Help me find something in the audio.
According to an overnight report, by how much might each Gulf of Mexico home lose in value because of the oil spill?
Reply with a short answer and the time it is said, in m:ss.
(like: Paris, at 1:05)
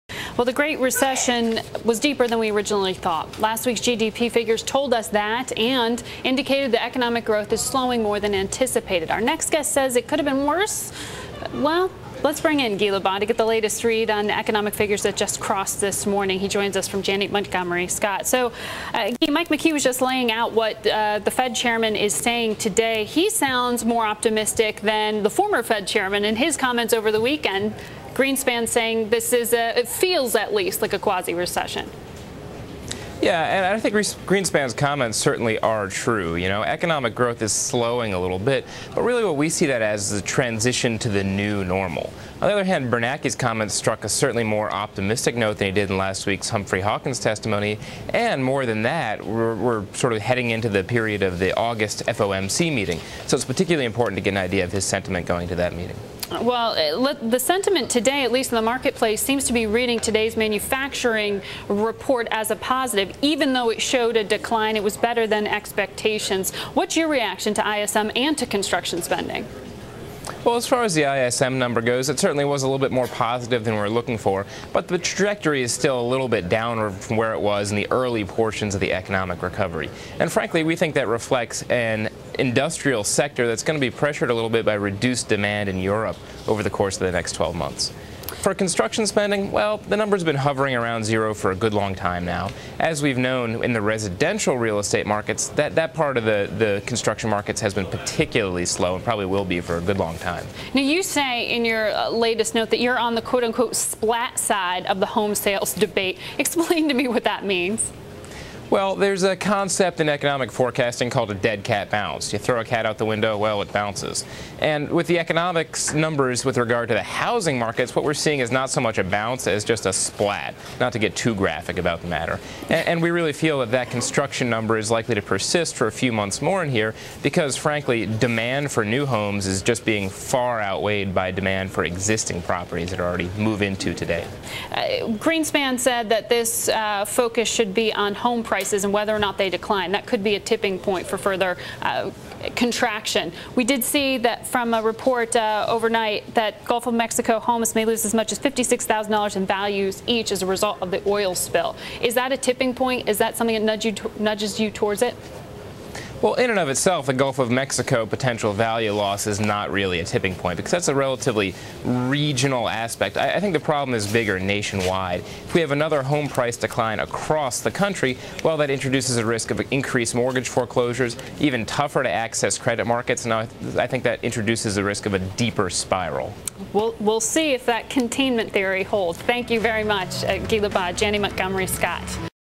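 $56,000, at 2:28.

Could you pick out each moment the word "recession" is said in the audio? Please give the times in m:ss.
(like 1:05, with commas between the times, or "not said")
0:00, 0:31.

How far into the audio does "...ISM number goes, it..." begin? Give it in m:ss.
1:11.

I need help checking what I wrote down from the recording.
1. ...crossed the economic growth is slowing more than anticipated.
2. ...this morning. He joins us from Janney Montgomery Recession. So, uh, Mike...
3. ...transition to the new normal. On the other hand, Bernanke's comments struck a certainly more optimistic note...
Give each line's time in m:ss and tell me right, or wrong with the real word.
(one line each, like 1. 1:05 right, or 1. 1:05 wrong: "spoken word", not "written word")
1. 0:06 wrong: "indicated", not "crossed"
2. 0:15 wrong: "Scott", not "Recession"
3. 0:40 right.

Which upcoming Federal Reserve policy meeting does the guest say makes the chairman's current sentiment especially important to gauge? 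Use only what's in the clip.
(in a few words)
August FOMC meeting.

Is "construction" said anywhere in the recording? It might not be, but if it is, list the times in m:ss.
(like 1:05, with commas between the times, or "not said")
1:08, 1:28, 1:36, 2:03.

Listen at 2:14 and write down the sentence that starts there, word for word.
Uh, Greenspan said that this uh, focus should be on home prices prices and whether or not they decline.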